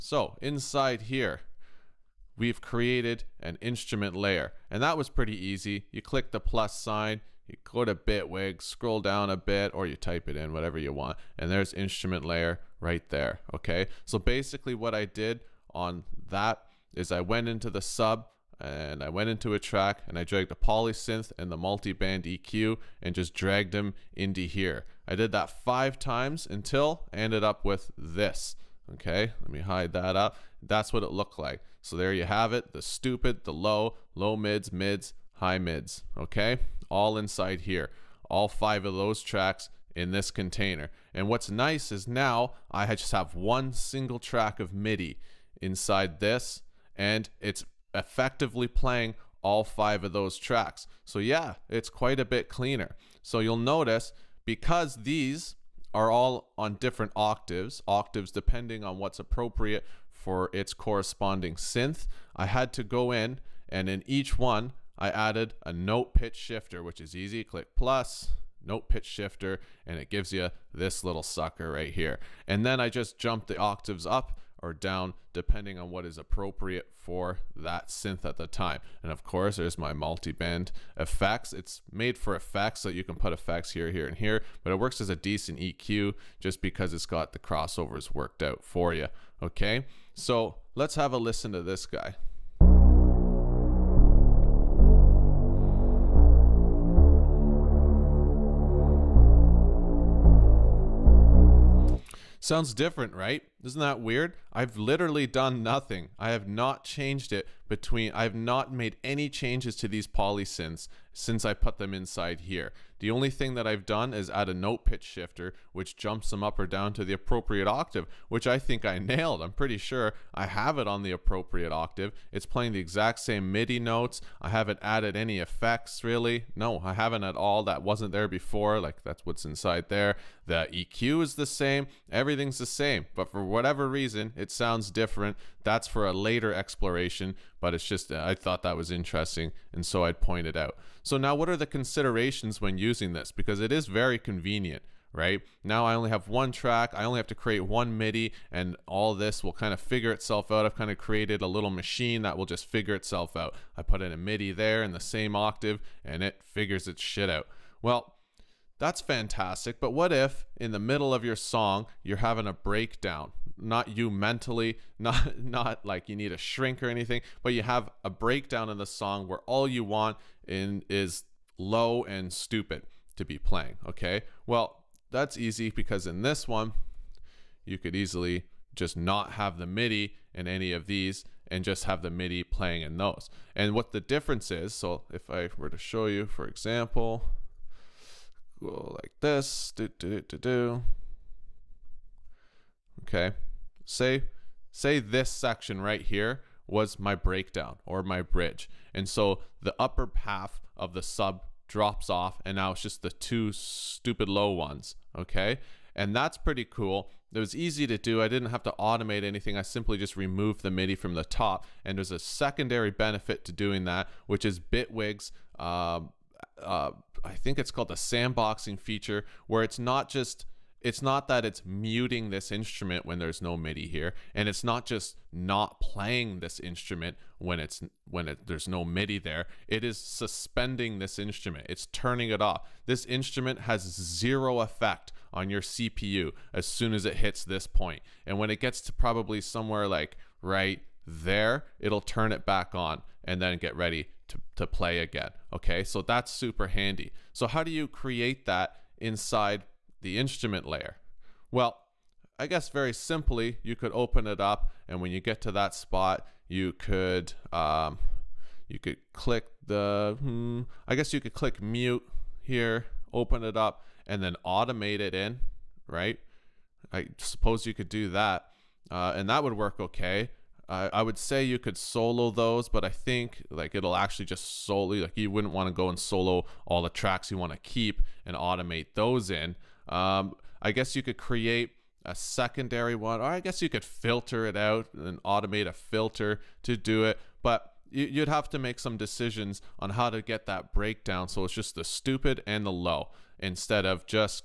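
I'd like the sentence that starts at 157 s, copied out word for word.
Well, that's fantastic, but what if in the middle of your song you're having a breakdown?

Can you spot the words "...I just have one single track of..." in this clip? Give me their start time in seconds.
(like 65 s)
42 s.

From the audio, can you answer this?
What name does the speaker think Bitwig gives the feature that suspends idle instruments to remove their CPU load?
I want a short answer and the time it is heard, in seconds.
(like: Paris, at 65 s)
sandboxing feature, at 217 s.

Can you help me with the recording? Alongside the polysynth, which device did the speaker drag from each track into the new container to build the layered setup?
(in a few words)
multi-band EQ.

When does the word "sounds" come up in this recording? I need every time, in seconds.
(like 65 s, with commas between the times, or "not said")
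102 s, 134 s.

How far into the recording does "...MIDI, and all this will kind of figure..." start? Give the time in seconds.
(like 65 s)
147 s.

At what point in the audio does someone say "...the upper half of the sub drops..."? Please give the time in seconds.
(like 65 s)
199 s.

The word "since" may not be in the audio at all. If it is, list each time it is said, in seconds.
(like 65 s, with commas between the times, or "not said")
111 s.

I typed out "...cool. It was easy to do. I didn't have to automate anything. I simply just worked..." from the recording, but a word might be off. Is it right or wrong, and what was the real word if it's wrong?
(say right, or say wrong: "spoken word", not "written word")
wrong: "removed", not "worked".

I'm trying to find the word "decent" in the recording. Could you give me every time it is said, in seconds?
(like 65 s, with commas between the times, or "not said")
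85 s.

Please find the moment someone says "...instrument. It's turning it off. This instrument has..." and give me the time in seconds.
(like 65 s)
231 s.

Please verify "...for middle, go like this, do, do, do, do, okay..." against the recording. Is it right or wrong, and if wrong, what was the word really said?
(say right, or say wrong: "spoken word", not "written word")
wrong: "example", not "middle".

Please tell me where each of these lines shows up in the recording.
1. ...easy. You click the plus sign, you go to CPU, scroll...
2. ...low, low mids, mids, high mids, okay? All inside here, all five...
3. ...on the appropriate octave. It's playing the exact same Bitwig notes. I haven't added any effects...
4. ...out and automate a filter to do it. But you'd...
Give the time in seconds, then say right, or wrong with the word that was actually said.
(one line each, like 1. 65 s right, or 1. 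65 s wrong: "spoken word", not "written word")
1. 5 s wrong: "Bitwig", not "CPU"
2. 33 s right
3. 120 s wrong: "MIDI", not "Bitwig"
4. 284 s right.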